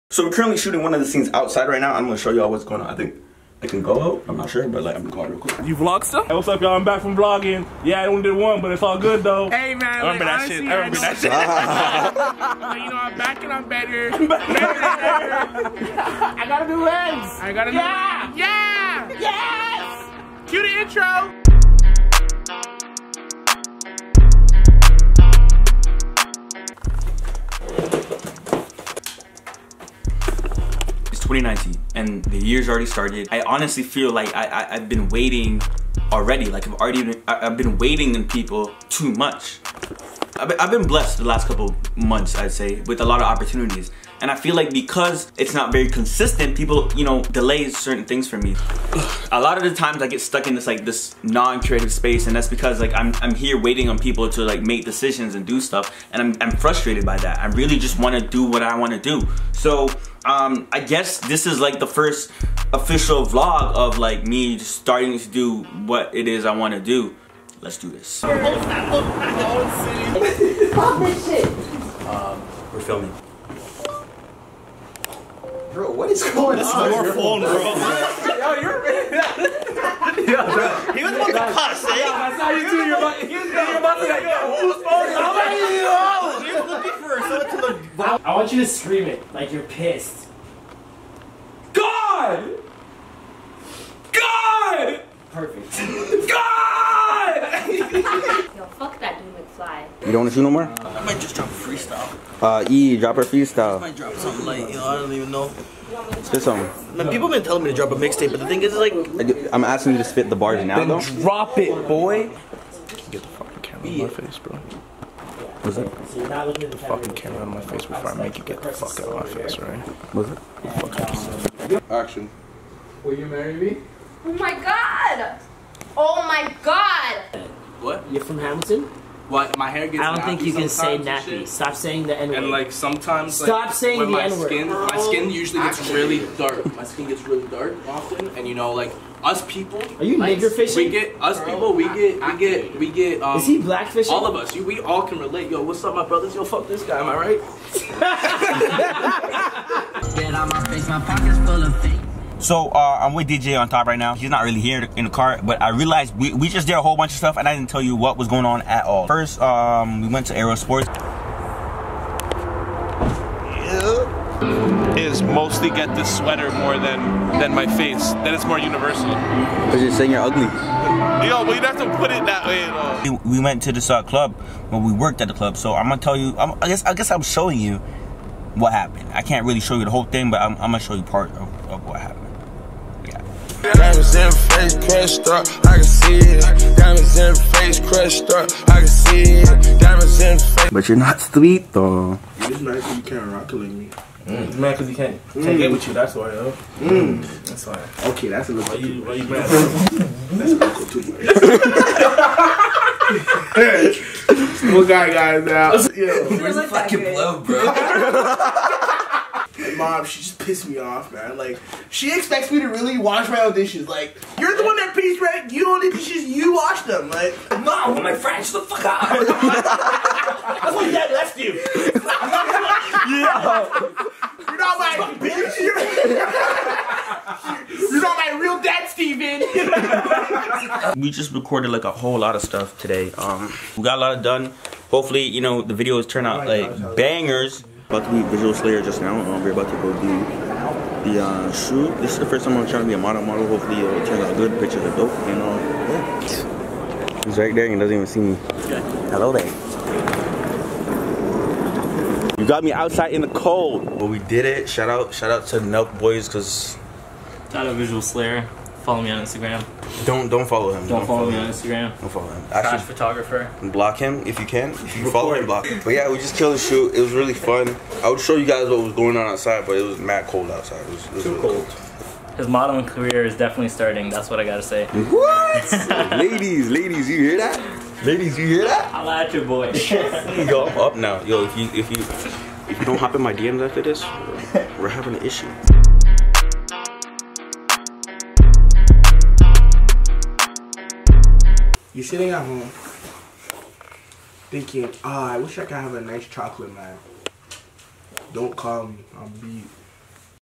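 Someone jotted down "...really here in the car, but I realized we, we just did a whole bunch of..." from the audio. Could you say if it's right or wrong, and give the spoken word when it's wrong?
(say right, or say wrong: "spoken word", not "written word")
right.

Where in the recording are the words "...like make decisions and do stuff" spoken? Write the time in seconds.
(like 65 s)
54 s.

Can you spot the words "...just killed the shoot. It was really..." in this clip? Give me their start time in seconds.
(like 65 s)
266 s.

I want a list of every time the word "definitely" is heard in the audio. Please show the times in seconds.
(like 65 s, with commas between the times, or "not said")
273 s.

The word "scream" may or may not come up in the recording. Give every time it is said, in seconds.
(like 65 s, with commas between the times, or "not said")
88 s.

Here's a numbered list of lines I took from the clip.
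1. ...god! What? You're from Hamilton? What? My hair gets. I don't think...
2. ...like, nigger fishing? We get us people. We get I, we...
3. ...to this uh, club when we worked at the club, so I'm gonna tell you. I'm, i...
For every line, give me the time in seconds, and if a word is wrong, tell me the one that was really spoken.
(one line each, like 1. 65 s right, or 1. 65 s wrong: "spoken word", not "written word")
1. 126 s right
2. 140 s right
3. 173 s right.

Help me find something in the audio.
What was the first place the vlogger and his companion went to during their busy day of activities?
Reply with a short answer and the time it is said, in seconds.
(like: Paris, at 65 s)
Aero Sports, at 160 s.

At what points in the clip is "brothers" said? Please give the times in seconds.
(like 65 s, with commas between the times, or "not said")
146 s.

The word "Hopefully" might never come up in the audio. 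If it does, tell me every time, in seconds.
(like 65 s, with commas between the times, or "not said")
234 s, 243 s.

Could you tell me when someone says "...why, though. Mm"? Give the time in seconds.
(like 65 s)
196 s.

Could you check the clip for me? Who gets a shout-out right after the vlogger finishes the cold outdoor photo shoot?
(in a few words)
Nelk Boys.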